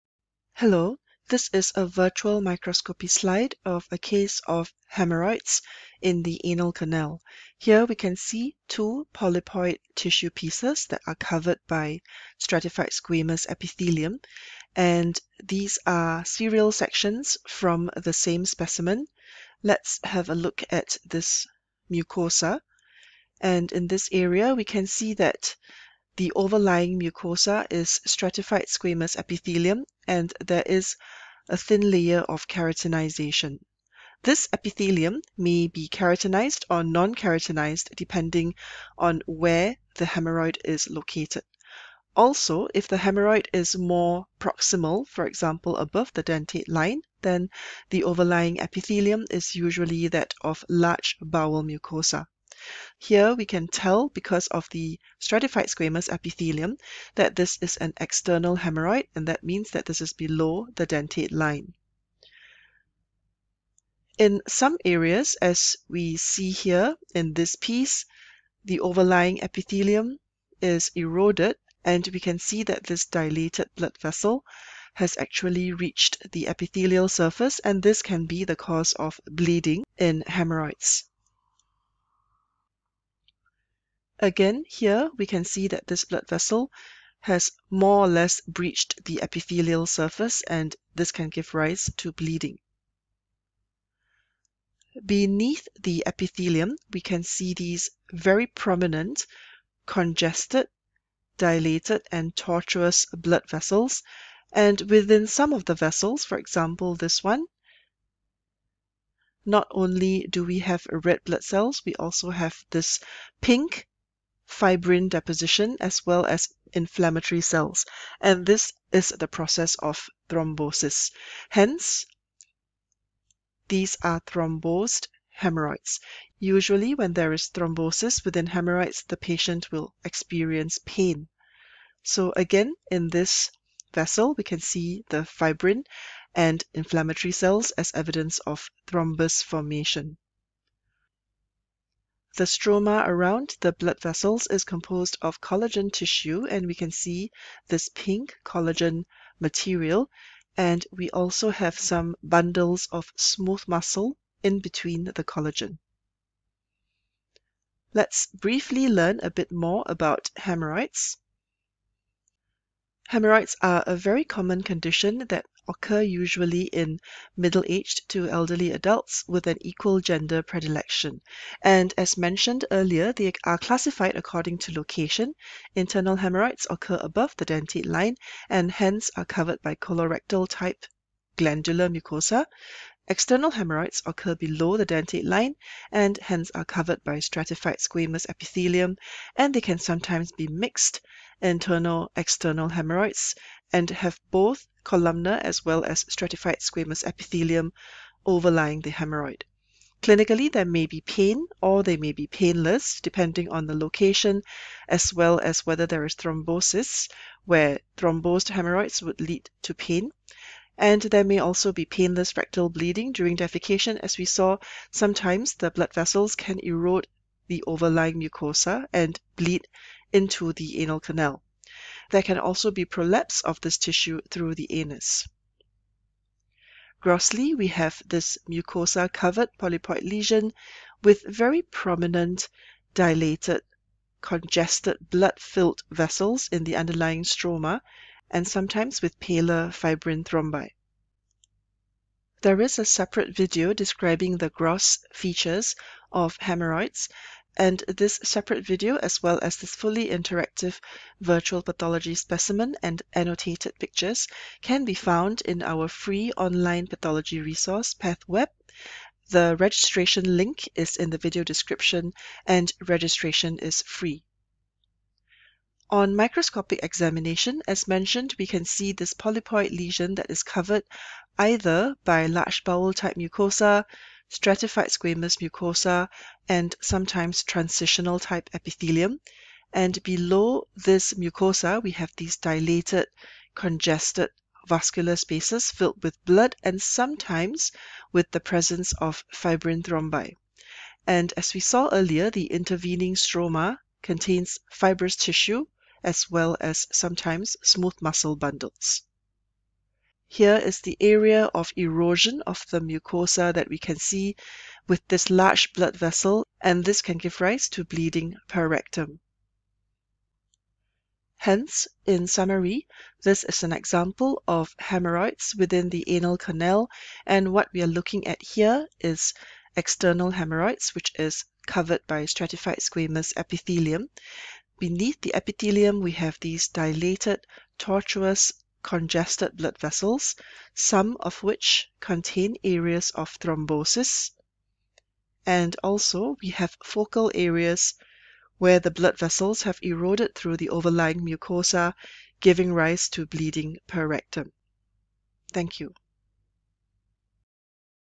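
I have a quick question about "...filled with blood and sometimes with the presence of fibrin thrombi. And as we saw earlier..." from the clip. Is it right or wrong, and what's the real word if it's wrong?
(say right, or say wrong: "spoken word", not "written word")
right.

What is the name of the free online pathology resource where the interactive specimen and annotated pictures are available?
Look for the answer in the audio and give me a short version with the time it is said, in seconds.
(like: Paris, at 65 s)
PathWeb, at 257 s.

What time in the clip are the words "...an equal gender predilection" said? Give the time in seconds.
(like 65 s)
169 s.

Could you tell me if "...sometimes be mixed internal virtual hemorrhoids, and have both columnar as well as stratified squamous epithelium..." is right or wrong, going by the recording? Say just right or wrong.
wrong.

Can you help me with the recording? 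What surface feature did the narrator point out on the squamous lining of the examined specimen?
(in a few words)
Keratinization.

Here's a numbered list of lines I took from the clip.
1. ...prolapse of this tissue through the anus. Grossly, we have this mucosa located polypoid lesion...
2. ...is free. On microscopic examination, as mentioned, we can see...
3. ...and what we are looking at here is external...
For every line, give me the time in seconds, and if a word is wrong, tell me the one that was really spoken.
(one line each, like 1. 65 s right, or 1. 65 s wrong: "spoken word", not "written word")
1. 222 s wrong: "covered", not "located"
2. 263 s right
3. 317 s right.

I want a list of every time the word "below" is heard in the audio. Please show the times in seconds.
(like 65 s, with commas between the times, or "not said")
60 s, 184 s, 280 s.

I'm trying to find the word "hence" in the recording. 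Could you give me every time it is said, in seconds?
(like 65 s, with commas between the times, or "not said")
121 s, 178 s, 186 s, 311 s.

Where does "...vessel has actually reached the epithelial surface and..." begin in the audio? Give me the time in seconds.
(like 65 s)
73 s.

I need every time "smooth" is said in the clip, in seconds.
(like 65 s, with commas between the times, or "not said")
153 s, 297 s.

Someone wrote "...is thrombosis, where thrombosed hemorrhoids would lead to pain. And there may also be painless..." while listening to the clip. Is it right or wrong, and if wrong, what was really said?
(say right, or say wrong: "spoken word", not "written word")
right.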